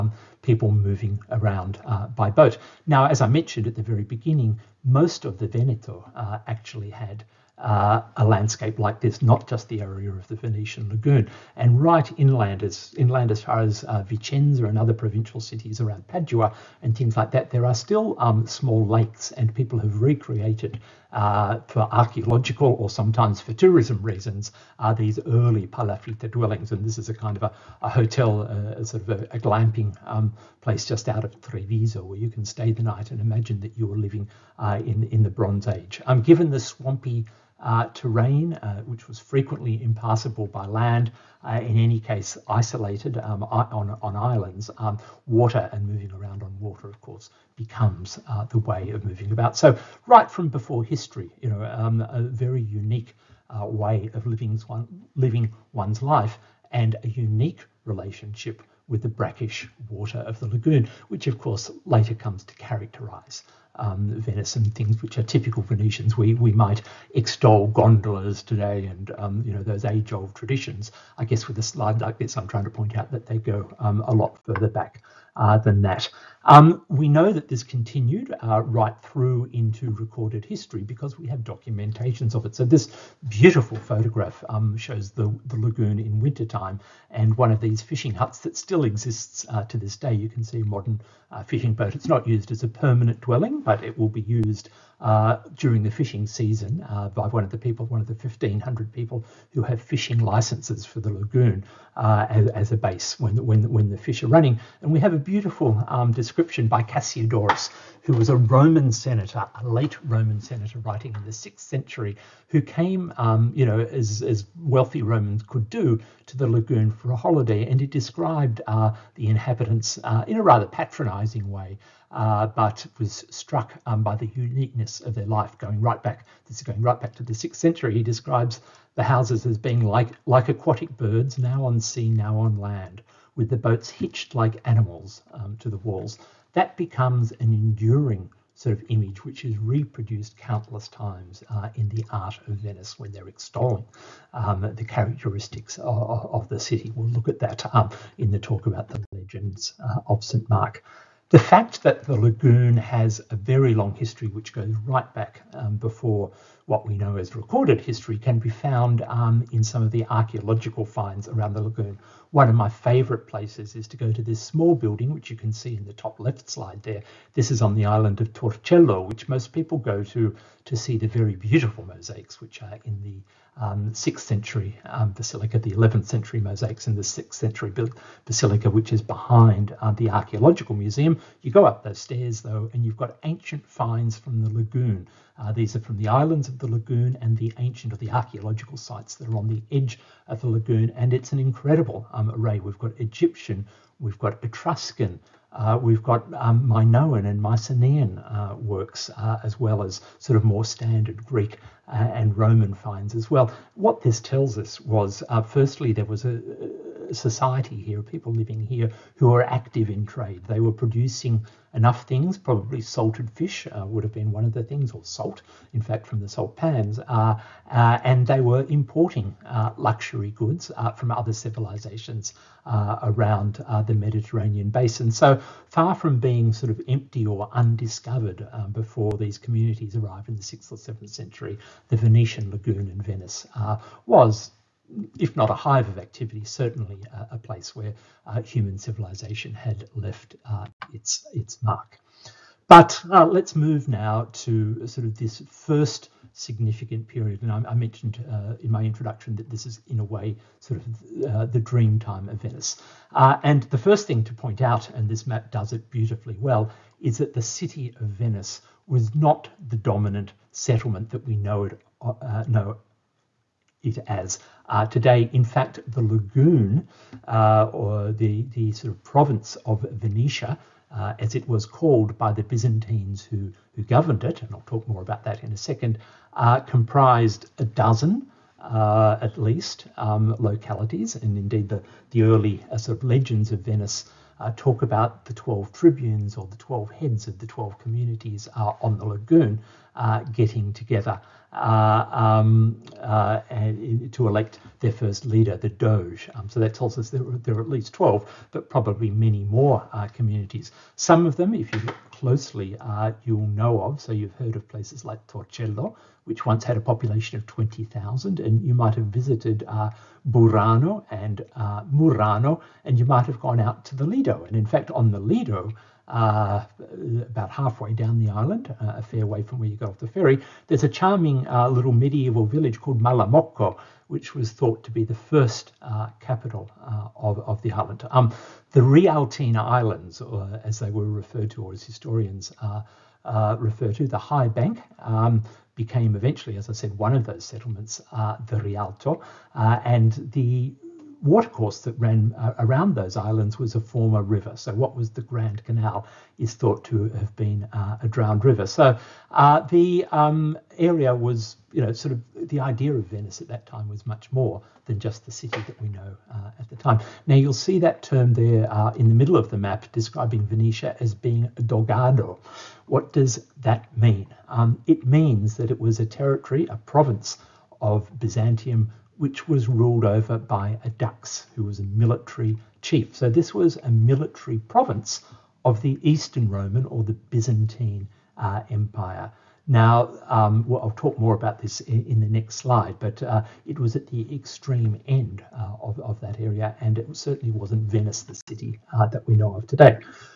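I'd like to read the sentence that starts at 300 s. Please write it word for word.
Some of them, if you look closely, you'll know of.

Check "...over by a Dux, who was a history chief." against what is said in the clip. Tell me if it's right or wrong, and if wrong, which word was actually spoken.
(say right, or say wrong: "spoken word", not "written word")
wrong: "military", not "history".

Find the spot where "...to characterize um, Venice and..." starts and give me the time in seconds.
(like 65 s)
62 s.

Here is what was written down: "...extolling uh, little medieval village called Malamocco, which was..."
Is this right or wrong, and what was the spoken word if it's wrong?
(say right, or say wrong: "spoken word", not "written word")
wrong: "charming", not "extolling".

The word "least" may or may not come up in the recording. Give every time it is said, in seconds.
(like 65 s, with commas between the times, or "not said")
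279 s, 297 s.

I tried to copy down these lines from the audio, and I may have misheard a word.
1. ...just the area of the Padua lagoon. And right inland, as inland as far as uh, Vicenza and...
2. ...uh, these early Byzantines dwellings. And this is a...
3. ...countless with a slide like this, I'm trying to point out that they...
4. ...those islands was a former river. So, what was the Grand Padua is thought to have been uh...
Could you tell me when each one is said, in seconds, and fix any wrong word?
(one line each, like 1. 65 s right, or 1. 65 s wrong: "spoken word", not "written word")
1. 9 s wrong: "Venetian", not "Padua"
2. 24 s wrong: "Palafitta", not "Byzantines"
3. 71 s wrong: "guess", not "countless"
4. 342 s wrong: "Canal", not "Padua".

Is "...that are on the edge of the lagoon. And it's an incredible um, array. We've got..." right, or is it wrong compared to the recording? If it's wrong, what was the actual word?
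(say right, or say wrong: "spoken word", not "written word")
right.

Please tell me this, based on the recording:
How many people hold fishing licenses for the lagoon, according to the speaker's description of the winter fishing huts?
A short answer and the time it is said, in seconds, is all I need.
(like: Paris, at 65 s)
1,500, at 98 s.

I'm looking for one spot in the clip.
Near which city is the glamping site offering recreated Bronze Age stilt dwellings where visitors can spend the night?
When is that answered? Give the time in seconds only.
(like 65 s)
31 s.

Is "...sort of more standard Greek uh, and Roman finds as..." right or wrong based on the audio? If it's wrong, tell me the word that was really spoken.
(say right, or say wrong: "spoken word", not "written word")
right.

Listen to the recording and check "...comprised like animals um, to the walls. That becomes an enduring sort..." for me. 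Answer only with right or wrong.
wrong.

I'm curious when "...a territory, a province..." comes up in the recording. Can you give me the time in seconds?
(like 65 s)
366 s.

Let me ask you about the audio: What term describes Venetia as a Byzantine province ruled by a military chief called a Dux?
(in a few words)
dogado.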